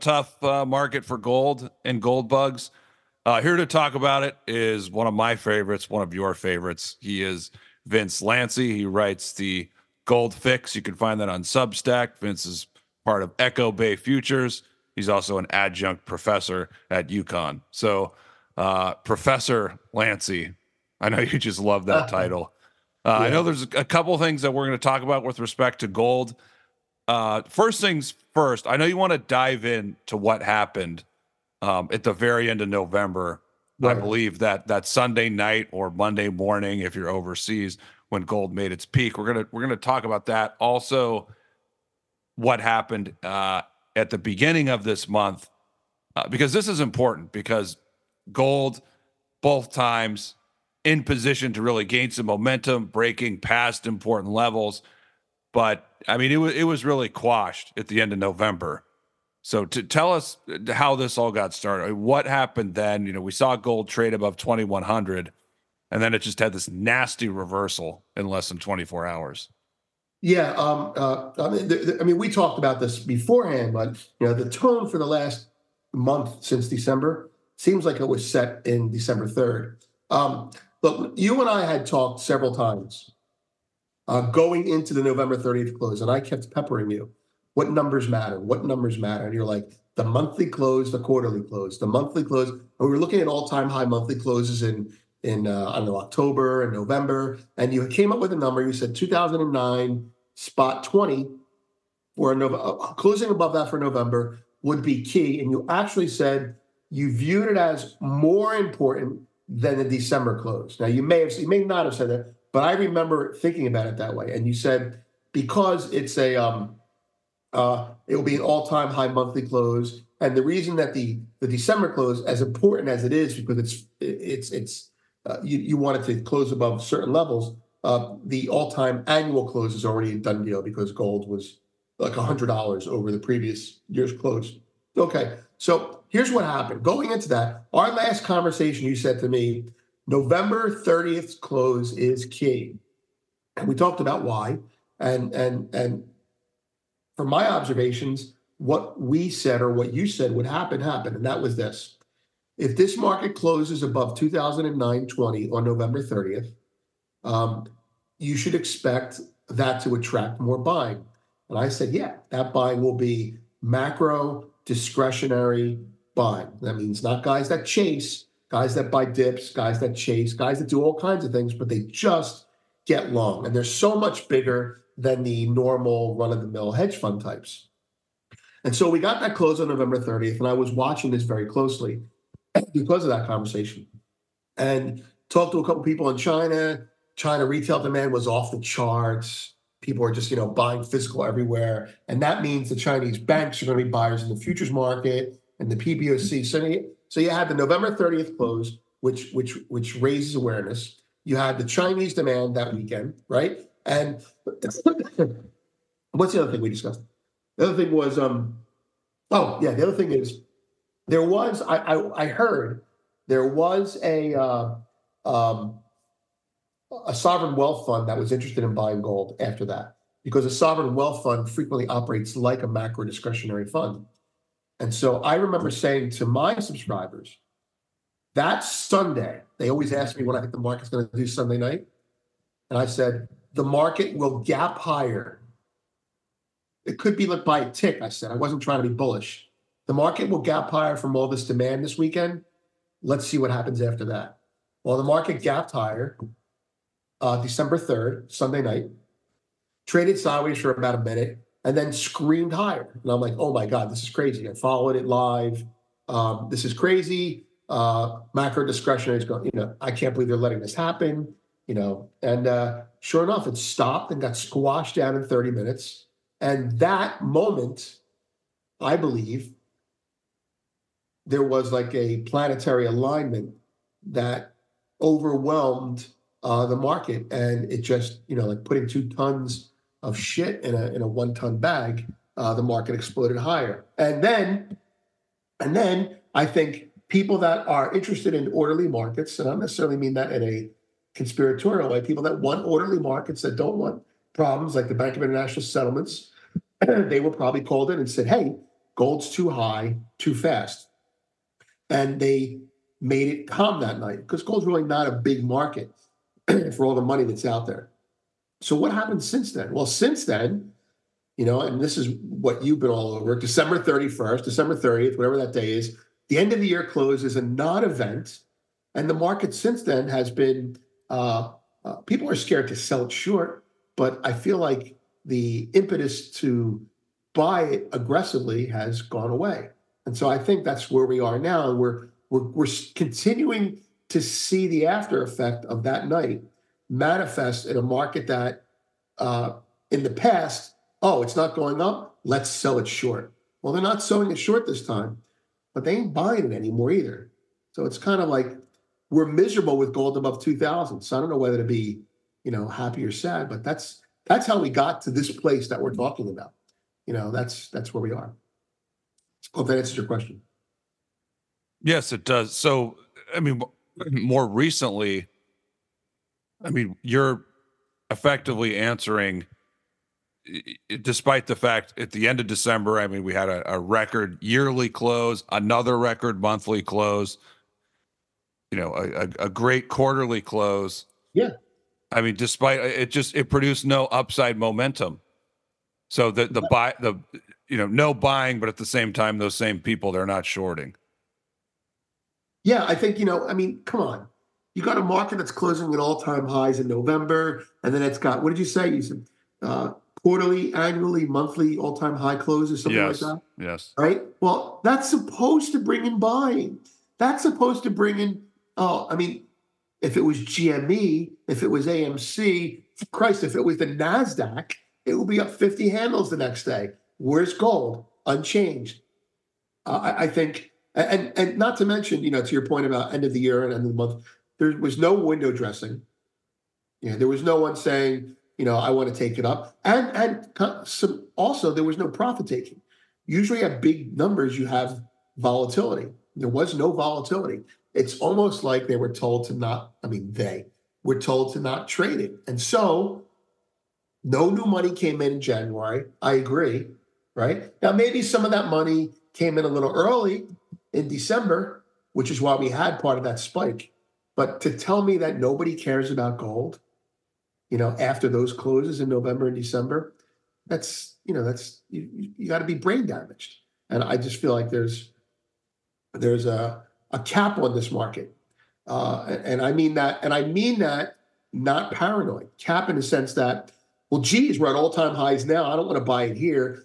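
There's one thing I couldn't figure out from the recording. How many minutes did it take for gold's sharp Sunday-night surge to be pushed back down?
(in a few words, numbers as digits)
30 minutes.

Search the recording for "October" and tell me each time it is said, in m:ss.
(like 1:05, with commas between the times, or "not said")
1:35.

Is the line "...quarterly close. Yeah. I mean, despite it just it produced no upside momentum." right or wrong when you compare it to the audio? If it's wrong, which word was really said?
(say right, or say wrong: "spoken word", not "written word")
right.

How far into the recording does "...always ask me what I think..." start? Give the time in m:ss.
3:49.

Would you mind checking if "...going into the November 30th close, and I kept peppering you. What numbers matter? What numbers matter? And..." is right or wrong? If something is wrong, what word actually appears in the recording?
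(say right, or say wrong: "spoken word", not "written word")
right.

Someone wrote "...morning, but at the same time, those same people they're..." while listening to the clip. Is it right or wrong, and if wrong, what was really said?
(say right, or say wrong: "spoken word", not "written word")
wrong: "buying", not "morning".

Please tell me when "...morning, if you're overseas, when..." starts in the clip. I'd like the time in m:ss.
0:36.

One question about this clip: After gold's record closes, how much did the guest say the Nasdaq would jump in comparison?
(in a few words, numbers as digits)
50 handles.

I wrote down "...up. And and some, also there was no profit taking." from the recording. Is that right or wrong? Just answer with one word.
right.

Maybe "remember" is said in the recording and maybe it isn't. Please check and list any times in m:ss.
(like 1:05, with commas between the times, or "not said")
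1:52, 3:45.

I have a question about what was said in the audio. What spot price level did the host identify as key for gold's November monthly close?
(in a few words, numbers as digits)
2009.20.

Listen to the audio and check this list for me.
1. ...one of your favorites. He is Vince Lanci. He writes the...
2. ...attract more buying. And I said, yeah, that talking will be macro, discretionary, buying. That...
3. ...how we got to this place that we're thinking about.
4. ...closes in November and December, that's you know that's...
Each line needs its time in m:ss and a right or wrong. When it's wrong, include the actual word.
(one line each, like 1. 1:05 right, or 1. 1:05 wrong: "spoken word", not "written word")
1. 0:05 right
2. 2:39 wrong: "buying", not "talking"
3. 5:54 wrong: "talking", not "thinking"
4. 7:38 right.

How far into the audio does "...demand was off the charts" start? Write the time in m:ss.
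3:07.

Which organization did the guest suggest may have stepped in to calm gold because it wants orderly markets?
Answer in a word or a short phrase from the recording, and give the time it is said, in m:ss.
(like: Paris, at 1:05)
Bank of International Settlements, at 4:54.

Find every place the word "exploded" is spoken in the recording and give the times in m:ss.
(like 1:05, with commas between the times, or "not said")
4:42.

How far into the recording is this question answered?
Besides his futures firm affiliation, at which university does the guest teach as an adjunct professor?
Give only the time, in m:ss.
0:17.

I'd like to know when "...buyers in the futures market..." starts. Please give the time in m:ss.
3:13.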